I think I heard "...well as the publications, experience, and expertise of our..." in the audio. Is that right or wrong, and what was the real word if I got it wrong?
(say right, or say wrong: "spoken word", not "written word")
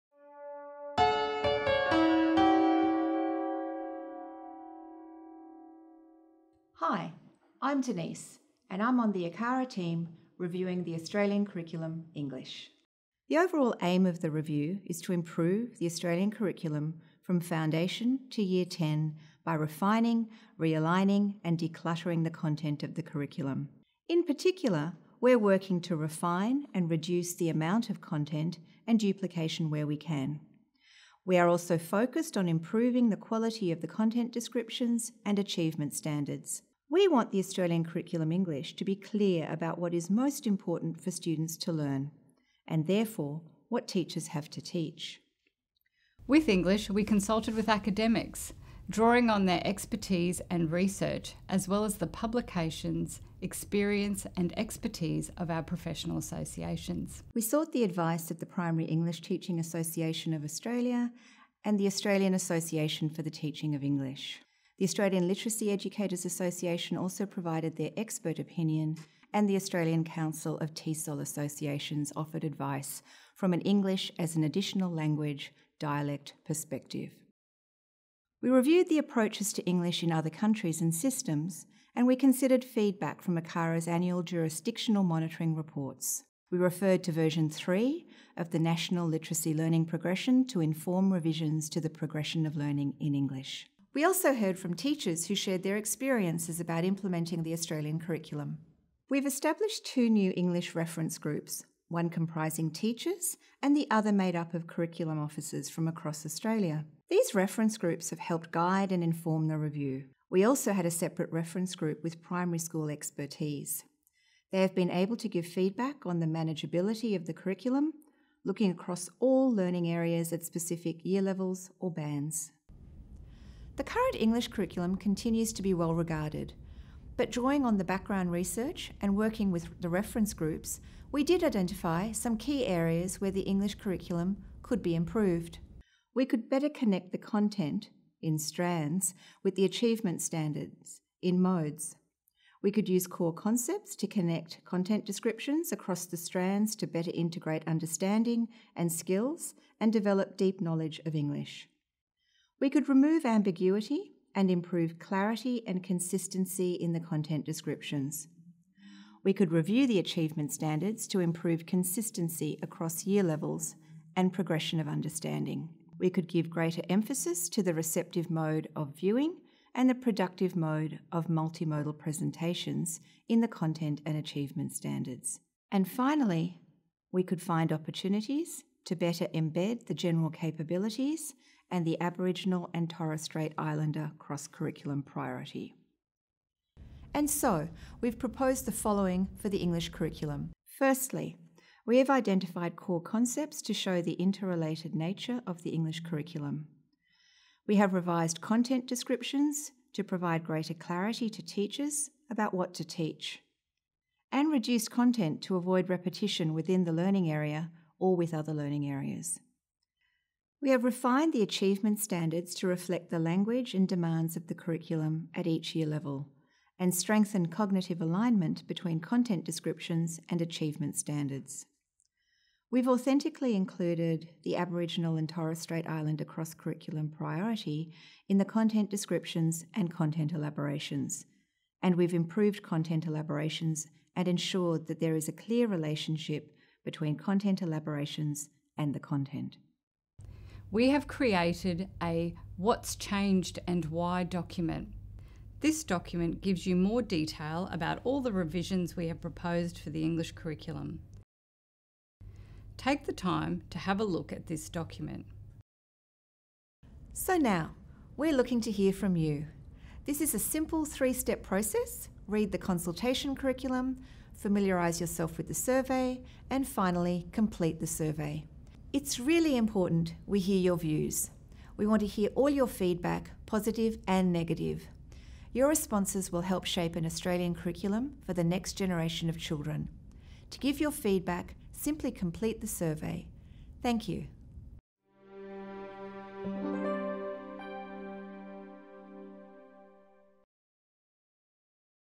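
right.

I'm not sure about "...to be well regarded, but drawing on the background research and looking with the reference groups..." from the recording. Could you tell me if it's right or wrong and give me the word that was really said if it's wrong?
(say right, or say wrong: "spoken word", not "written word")
wrong: "working", not "looking".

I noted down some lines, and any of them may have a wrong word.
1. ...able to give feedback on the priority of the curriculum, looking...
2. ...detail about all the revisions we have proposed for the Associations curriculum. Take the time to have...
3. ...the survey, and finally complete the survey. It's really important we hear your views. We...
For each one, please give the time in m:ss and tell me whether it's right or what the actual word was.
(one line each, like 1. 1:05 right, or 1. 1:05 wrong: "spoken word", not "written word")
1. 1:54 wrong: "manageability", not "priority"
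2. 4:07 wrong: "English", not "Associations"
3. 4:25 right.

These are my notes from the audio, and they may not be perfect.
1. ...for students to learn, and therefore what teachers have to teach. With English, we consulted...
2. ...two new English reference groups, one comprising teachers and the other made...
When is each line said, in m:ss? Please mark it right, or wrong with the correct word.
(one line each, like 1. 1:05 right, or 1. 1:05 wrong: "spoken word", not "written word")
1. 0:40 right
2. 1:39 right.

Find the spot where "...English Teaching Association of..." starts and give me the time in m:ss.
0:58.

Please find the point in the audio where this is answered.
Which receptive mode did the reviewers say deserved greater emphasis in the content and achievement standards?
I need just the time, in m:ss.
2:48.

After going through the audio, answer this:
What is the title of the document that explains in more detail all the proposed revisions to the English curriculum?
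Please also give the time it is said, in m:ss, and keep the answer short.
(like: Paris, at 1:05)
What's Changed and Why, at 4:02.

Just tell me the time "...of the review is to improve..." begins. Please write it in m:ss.
0:14.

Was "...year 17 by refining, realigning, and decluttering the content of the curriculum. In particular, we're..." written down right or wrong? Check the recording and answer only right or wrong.
wrong.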